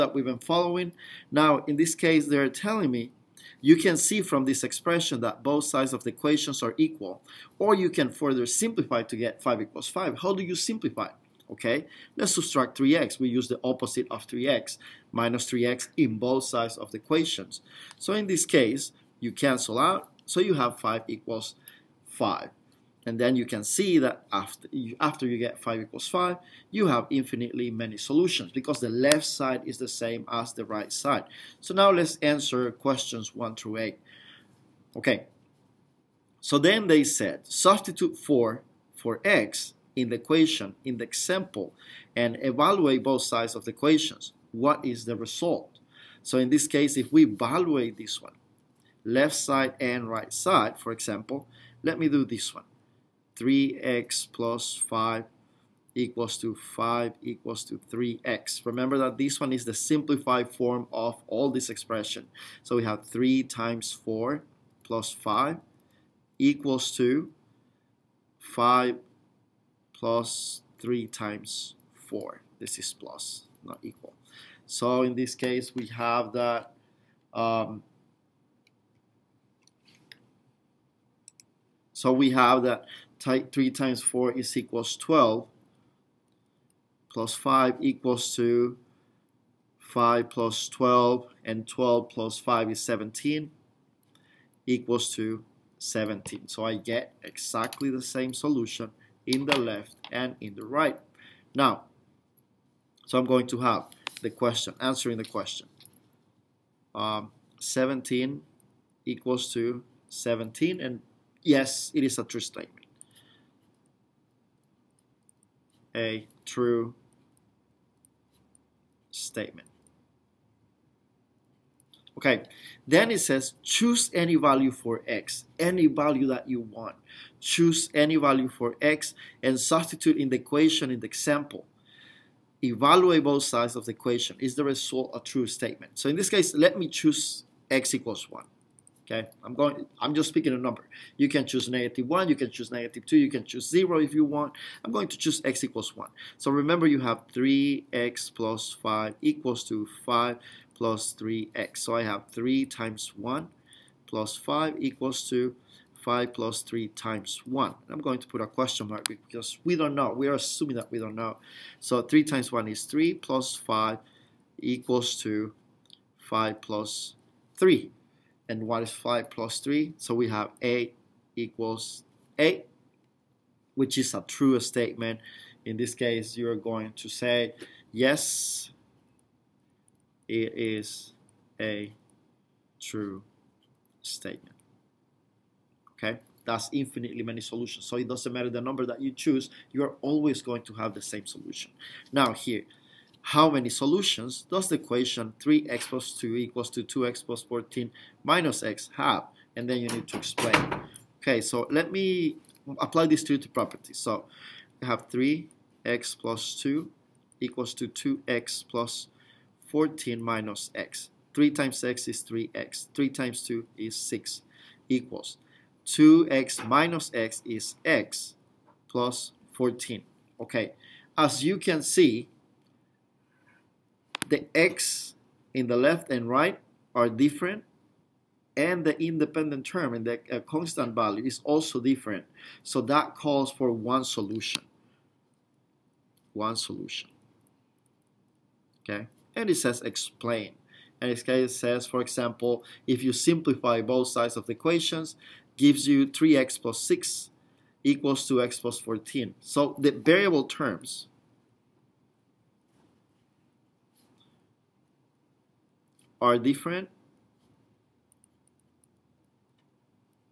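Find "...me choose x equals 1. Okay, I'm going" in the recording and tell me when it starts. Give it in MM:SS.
02:16.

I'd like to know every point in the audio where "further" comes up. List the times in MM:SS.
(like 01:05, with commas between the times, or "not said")
00:08.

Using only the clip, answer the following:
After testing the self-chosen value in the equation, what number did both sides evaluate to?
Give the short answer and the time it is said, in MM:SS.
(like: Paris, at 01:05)
8, at 02:50.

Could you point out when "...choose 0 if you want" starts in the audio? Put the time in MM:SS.
02:23.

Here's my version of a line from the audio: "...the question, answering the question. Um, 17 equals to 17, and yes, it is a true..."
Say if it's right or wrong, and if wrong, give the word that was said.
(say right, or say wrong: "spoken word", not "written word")
right.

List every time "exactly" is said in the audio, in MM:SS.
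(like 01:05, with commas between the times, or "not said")
01:37.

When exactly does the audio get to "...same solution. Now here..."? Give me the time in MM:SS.
03:11.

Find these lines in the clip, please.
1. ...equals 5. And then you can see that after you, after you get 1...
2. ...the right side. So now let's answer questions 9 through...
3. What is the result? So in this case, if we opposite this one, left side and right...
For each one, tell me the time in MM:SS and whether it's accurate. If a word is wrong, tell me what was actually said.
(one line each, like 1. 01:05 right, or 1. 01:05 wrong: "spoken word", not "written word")
1. 00:21 wrong: "5", not "1"
2. 00:30 wrong: "1", not "9"
3. 00:44 wrong: "evaluate", not "opposite".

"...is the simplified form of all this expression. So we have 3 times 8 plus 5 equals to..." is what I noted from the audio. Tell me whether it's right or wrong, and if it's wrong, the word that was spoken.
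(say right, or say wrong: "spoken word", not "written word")
wrong: "4", not "8".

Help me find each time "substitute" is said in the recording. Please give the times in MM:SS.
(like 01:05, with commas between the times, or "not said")
00:37, 02:09.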